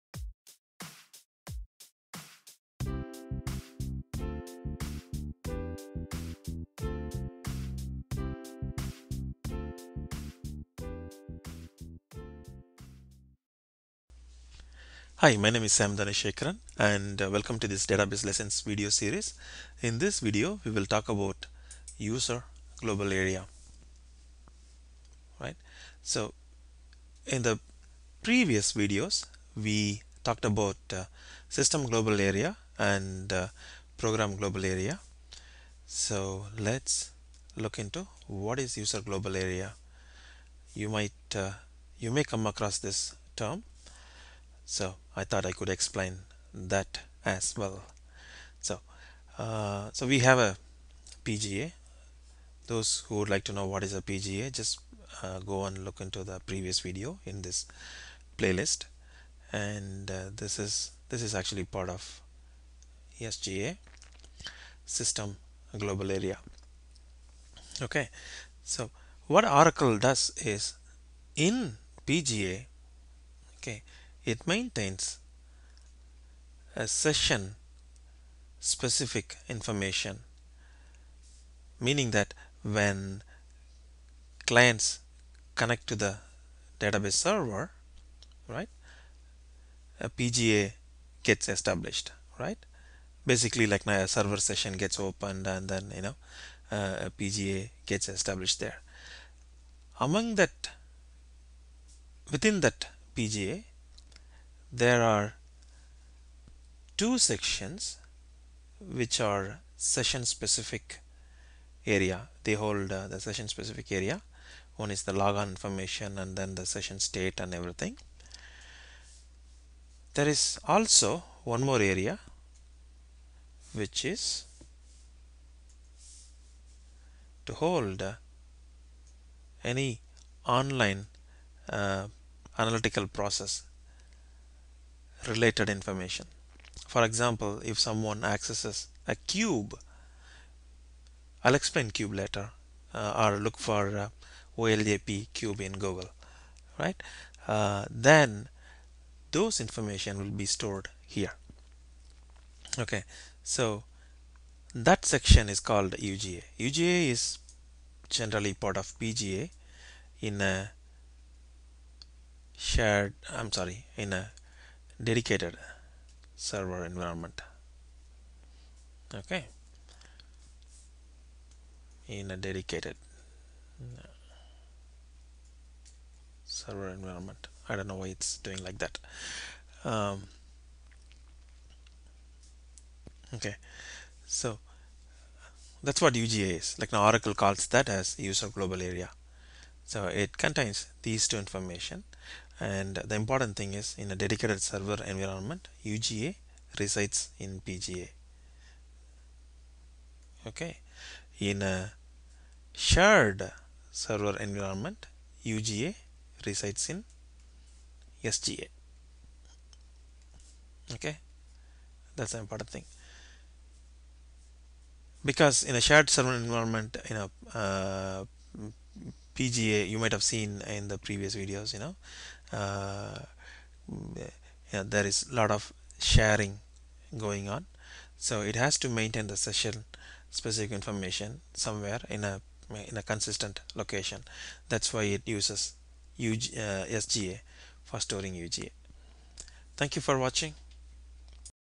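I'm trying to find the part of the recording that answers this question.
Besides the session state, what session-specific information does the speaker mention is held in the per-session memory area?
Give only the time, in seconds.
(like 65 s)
115 s.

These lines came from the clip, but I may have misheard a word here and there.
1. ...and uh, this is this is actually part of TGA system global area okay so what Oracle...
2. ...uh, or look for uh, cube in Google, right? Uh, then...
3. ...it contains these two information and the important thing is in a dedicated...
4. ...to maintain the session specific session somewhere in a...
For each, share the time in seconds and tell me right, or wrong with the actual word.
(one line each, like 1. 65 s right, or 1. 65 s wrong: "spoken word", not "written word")
1. 59 s wrong: "SGA", not "TGA"
2. 142 s right
3. 190 s right
4. 228 s wrong: "information", not "session".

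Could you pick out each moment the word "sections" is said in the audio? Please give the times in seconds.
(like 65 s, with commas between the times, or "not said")
107 s, 155 s.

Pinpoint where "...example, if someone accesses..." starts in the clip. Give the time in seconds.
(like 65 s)
137 s.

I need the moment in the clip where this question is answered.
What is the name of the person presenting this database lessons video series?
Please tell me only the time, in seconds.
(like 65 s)
15 s.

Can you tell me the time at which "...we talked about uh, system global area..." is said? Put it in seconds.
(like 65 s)
29 s.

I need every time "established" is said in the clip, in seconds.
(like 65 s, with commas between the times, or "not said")
91 s, 98 s.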